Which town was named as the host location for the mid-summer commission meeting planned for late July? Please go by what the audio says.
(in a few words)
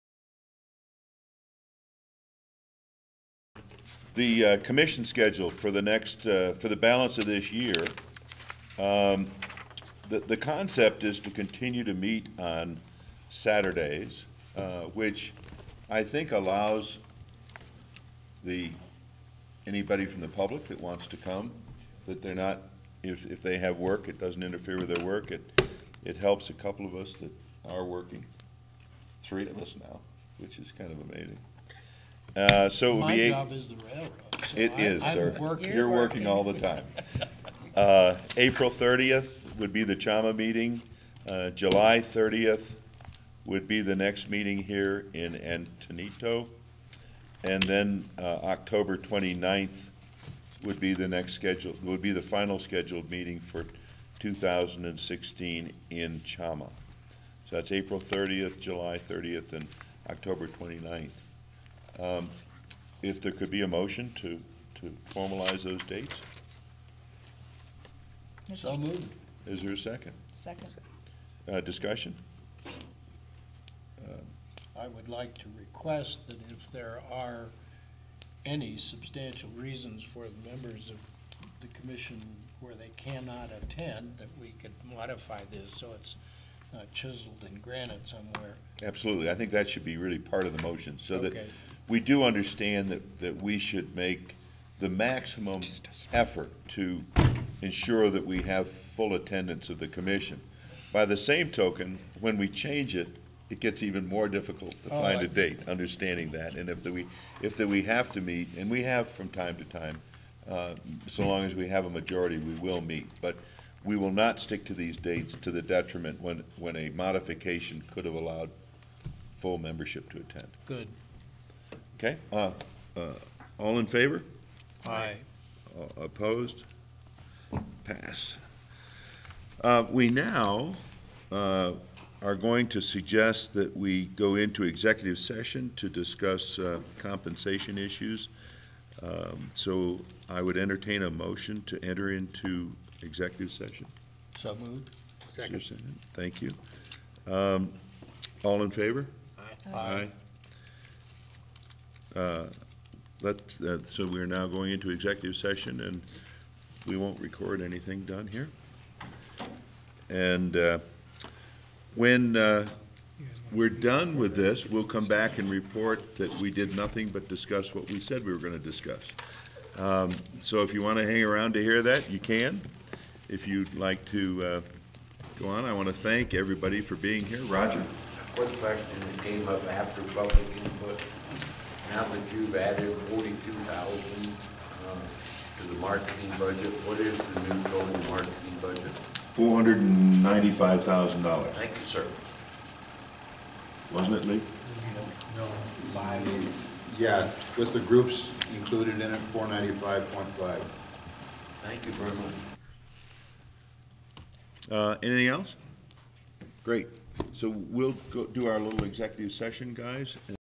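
Antonito.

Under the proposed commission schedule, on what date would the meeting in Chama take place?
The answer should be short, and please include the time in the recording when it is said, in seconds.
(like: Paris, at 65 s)
April 30th, at 38 s.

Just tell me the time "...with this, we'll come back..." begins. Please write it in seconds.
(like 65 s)
164 s.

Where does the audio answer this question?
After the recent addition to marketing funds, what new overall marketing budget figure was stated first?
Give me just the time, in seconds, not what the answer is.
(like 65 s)
189 s.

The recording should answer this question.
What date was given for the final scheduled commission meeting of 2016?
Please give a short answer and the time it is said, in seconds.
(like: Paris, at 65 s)
October 29th, at 48 s.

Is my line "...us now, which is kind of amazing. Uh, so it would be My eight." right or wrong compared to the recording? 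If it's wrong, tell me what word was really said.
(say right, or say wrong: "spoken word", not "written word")
right.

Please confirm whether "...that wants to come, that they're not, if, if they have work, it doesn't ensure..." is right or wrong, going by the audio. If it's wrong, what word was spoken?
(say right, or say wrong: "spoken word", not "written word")
wrong: "interfere", not "ensure".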